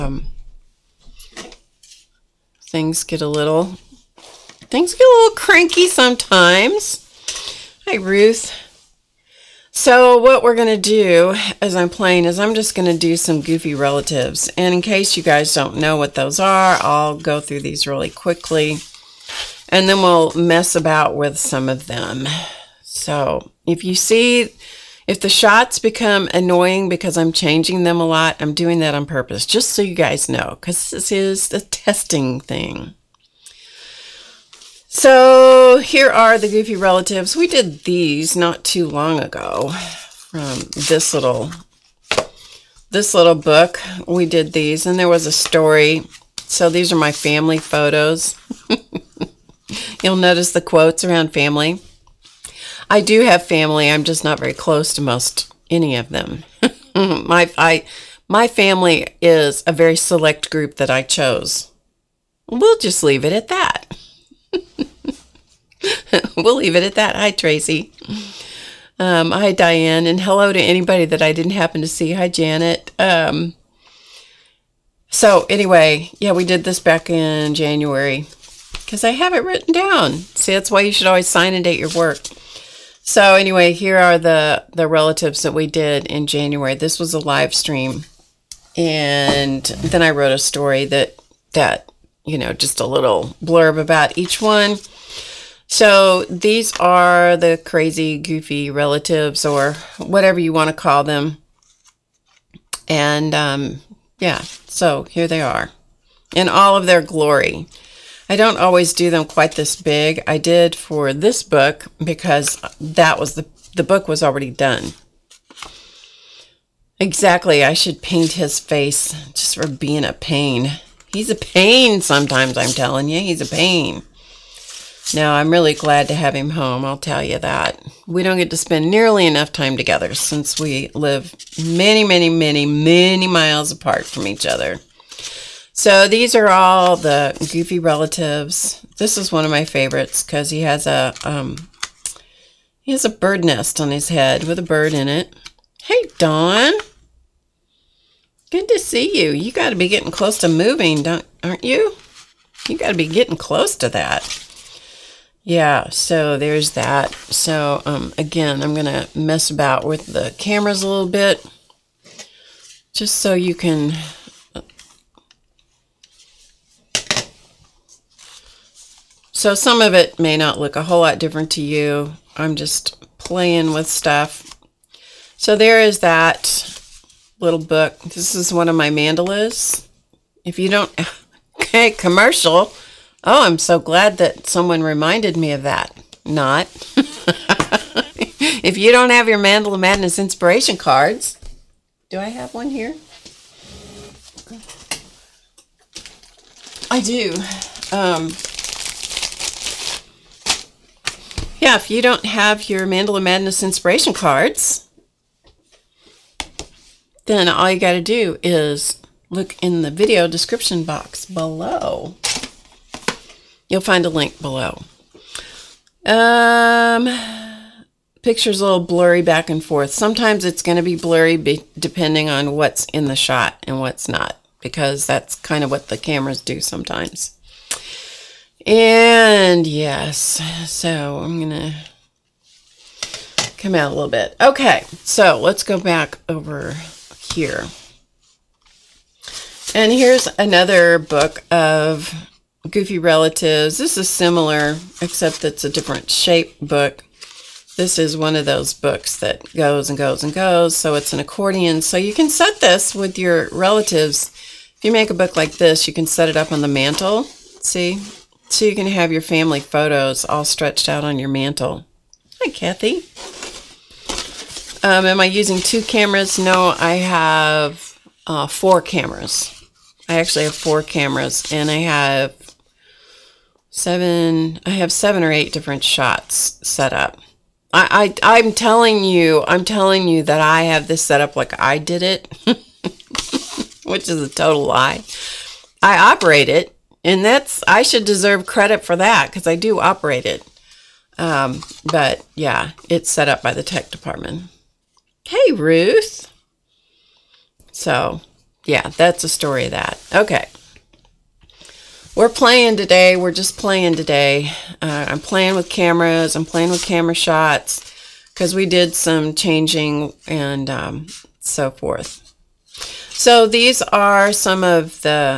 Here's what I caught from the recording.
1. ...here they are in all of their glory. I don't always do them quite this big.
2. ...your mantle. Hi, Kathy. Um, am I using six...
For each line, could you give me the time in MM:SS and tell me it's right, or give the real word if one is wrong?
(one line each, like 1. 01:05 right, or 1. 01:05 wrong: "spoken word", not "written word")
1. 01:45 right
2. 04:21 wrong: "two", not "six".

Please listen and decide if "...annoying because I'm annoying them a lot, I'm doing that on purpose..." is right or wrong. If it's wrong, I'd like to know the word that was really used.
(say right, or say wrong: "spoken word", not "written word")
wrong: "changing", not "annoying".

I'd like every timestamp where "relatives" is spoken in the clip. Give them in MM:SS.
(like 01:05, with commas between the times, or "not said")
00:13, 00:36, 01:24, 01:38, 02:17, 04:02, 04:13.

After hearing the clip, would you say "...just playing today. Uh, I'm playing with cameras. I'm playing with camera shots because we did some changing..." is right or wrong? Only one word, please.
right.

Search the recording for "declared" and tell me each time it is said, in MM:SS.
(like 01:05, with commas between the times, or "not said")
not said.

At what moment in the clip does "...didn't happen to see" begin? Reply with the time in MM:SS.
01:11.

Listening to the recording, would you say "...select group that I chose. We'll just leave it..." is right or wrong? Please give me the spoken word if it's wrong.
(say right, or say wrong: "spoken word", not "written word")
right.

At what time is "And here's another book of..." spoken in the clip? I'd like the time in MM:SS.
03:59.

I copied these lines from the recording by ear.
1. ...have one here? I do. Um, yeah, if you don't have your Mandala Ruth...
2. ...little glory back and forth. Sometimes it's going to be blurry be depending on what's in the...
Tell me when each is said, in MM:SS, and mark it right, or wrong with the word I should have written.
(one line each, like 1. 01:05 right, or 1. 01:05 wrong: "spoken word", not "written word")
1. 03:12 wrong: "Madness", not "Ruth"
2. 03:38 wrong: "blurry", not "glory".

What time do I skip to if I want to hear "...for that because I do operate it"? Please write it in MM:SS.
04:48.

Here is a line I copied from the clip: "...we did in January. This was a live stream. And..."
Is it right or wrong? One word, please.
right.